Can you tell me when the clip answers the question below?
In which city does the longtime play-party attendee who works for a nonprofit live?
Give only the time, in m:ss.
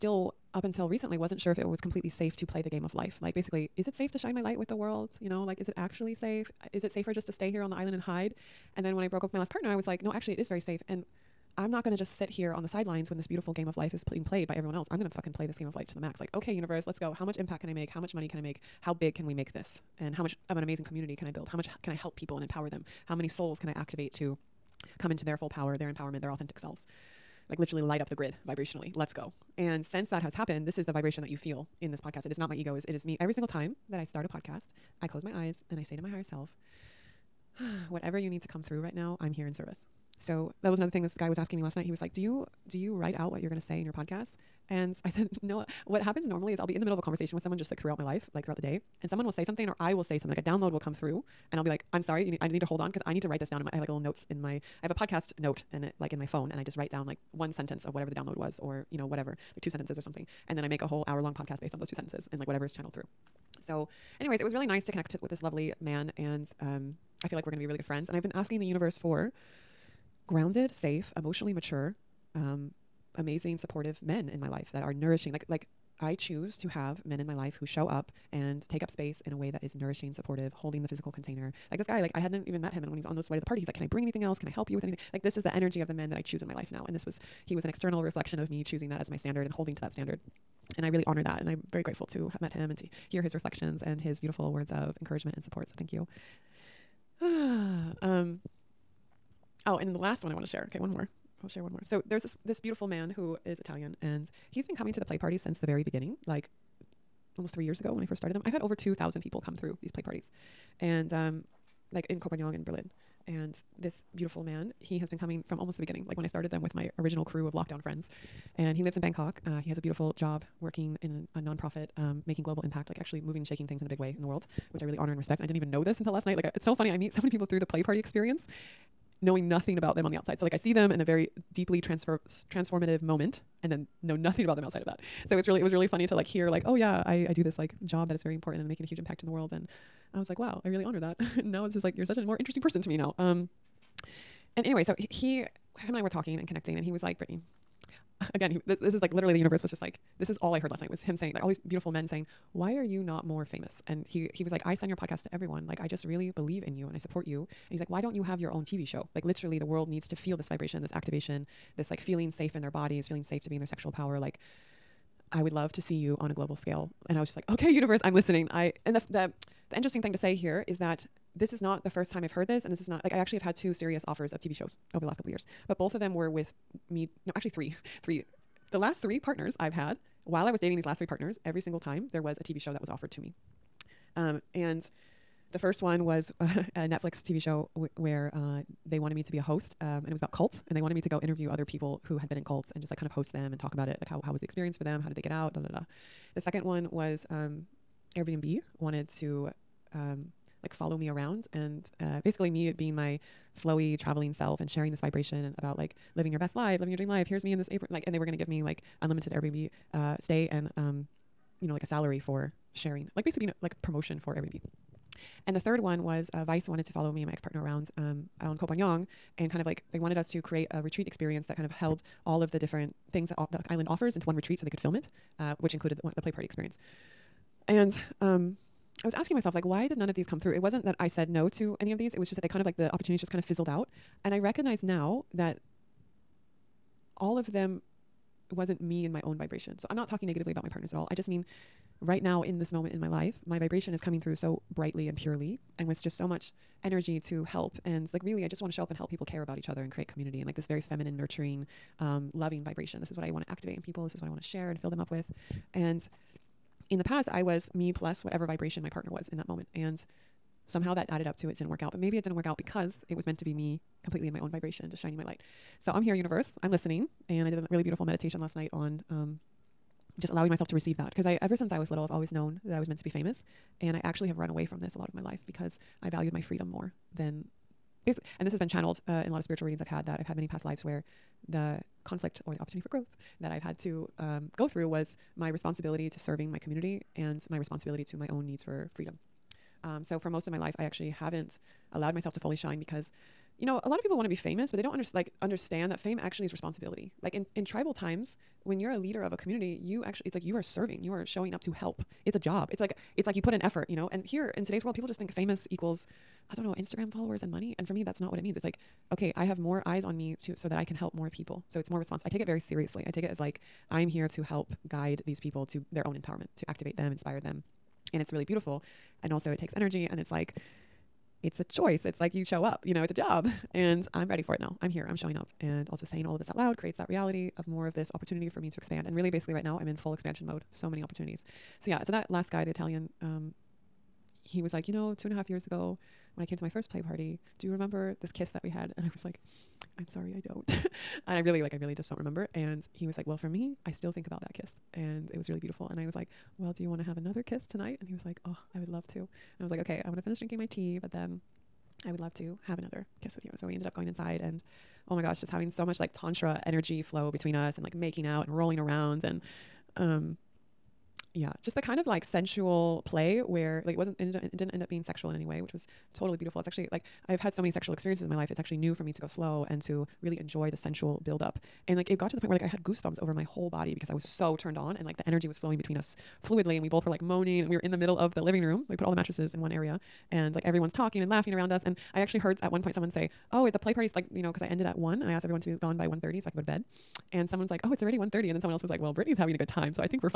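1:59.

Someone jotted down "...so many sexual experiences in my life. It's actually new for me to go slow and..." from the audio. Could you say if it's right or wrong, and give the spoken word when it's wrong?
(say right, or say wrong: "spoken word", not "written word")
right.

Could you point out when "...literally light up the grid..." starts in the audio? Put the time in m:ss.
0:27.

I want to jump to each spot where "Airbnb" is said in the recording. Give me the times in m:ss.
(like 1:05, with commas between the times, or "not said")
3:18, 3:29, 3:34.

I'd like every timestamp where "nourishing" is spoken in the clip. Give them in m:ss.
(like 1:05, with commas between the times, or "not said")
1:14, 1:19.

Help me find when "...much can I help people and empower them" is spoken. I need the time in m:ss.
0:21.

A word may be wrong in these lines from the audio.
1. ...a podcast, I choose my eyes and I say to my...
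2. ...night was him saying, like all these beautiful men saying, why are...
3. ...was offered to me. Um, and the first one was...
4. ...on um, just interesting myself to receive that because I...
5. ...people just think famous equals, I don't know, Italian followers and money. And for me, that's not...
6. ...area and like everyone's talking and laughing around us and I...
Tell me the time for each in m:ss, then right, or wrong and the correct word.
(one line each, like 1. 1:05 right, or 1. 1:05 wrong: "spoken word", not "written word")
1. 0:34 wrong: "close", not "choose"
2. 2:30 right
3. 3:02 right
4. 4:28 wrong: "allowing", not "interesting"
5. 5:04 wrong: "Instagram", not "Italian"
6. 6:19 right.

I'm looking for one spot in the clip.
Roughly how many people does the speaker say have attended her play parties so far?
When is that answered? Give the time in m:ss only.
1:48.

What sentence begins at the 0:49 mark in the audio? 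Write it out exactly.
And someone will say something, or I will say something, like a download will come through.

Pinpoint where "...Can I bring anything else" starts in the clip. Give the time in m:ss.
1:23.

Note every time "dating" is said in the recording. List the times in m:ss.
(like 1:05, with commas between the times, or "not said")
3:00.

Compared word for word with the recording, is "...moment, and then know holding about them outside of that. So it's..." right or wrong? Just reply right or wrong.
wrong.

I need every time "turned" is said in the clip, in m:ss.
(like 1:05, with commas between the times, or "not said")
6:14.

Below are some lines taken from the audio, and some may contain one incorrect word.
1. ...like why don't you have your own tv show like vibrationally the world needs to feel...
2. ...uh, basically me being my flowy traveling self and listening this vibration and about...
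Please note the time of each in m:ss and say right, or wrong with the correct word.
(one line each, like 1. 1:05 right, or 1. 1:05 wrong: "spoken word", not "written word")
1. 2:37 wrong: "literally", not "vibrationally"
2. 3:22 wrong: "sharing", not "listening".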